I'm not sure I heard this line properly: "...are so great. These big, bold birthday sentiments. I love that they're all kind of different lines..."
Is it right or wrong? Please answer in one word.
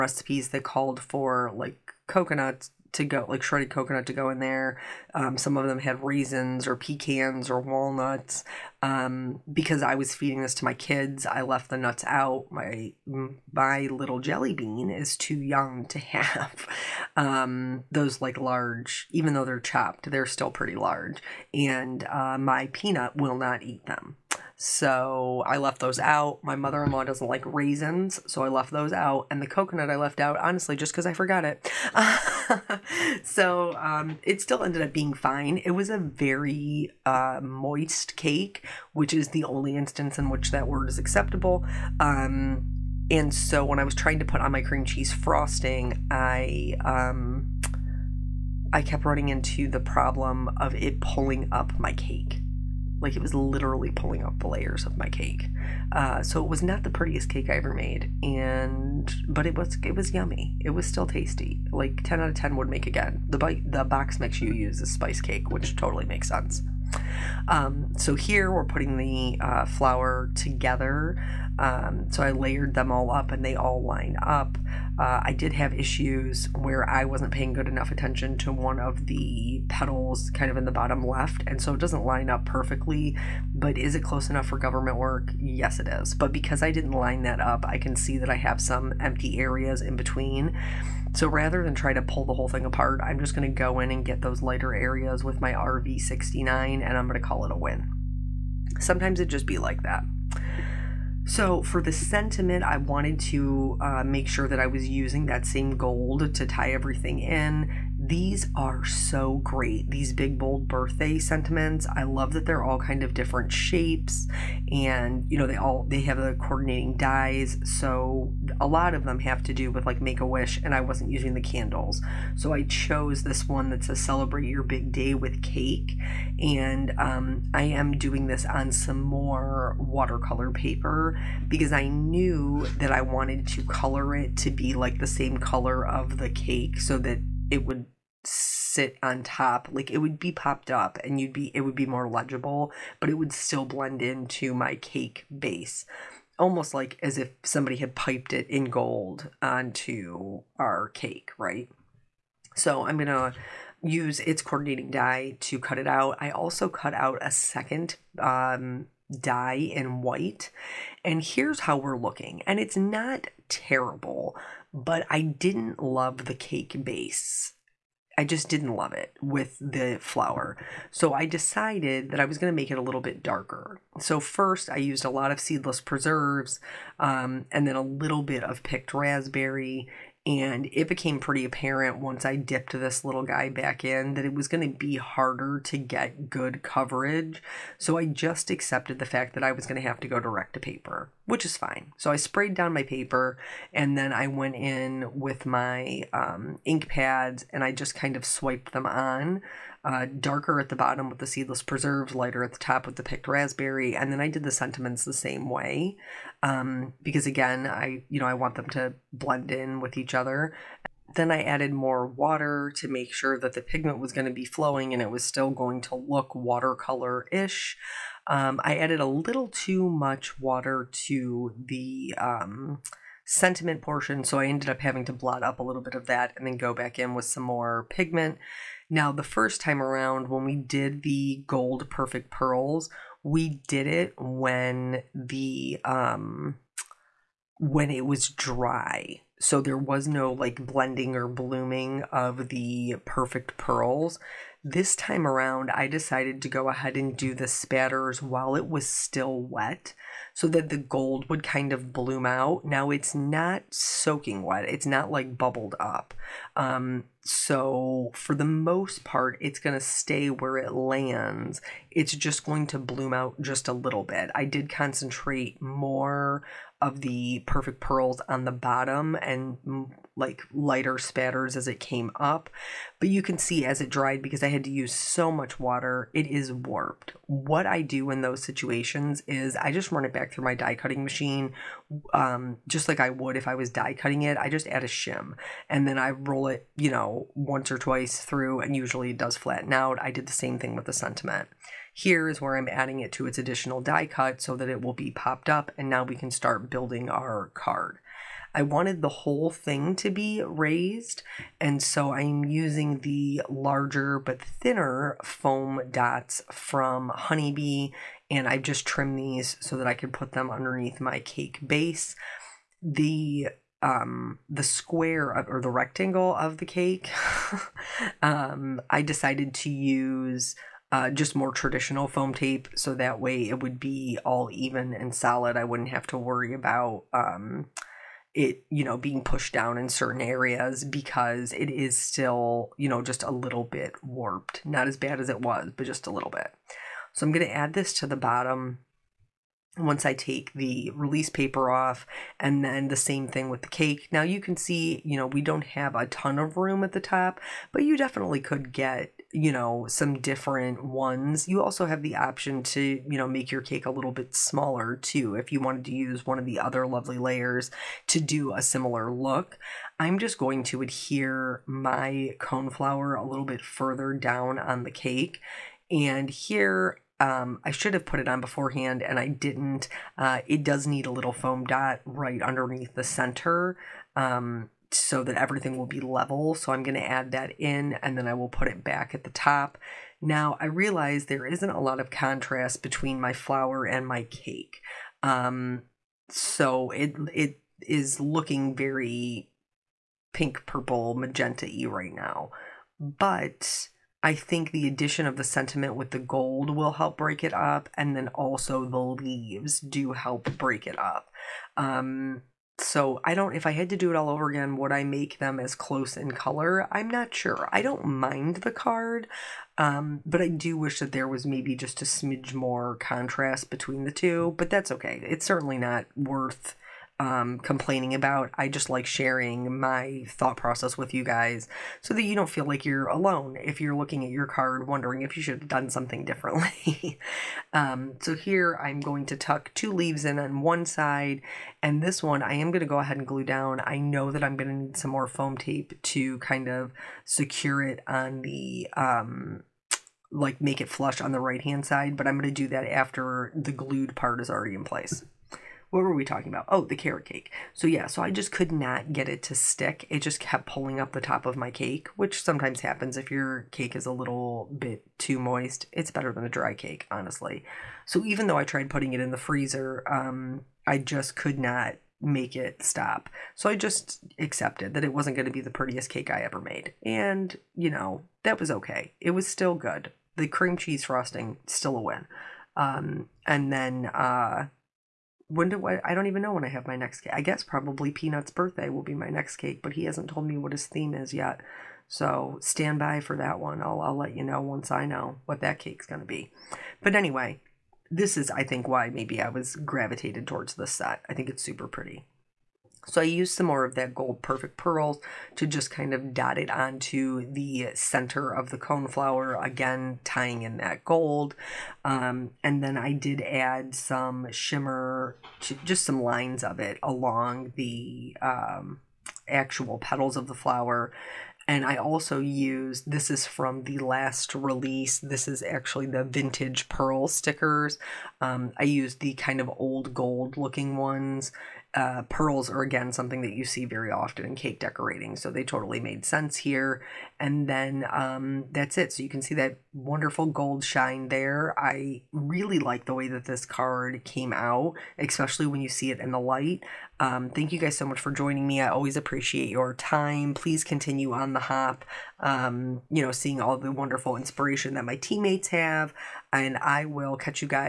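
wrong.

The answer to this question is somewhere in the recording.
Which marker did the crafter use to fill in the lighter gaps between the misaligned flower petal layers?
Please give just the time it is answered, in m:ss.
1:35.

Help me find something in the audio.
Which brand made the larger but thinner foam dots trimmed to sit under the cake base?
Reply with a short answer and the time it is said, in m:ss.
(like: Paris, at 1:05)
Honeybee, at 5:07.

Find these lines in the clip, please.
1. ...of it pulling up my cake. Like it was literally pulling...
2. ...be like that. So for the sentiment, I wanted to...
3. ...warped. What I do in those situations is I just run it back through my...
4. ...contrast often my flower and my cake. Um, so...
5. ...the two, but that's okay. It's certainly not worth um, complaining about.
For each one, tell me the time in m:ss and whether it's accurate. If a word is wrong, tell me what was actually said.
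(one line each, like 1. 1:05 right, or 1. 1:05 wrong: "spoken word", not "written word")
1. 0:50 right
2. 1:39 right
3. 4:36 right
4. 6:22 wrong: "between", not "often"
5. 6:54 right.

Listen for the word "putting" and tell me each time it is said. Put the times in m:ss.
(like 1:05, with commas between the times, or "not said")
1:08, 7:38.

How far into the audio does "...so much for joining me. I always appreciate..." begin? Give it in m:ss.
8:57.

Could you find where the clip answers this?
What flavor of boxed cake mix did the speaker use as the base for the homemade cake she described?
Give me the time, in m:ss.
1:04.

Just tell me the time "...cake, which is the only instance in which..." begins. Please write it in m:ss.
0:38.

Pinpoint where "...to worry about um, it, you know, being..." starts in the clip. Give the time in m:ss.
5:26.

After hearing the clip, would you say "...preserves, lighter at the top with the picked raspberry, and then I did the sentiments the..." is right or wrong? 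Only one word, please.
right.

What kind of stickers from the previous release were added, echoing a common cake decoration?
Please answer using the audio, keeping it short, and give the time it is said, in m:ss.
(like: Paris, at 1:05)
Vintage pearl stickers, at 8:36.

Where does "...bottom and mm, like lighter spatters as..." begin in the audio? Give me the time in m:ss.
4:28.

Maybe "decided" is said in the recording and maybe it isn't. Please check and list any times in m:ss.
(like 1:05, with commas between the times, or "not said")
2:51, 4:05, 5:19.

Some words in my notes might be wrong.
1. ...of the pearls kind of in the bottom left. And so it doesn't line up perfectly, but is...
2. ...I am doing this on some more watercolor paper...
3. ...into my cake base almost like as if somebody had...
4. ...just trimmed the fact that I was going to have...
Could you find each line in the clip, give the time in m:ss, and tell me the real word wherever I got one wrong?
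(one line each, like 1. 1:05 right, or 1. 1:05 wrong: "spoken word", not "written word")
1. 1:18 wrong: "pedals", not "pearls"
2. 2:07 right
3. 2:24 right
4. 3:08 wrong: "accepted", not "trimmed".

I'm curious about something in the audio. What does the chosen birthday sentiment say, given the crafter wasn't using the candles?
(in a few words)
Celebrate your big day with cake.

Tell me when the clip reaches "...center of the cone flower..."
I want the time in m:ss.
8:17.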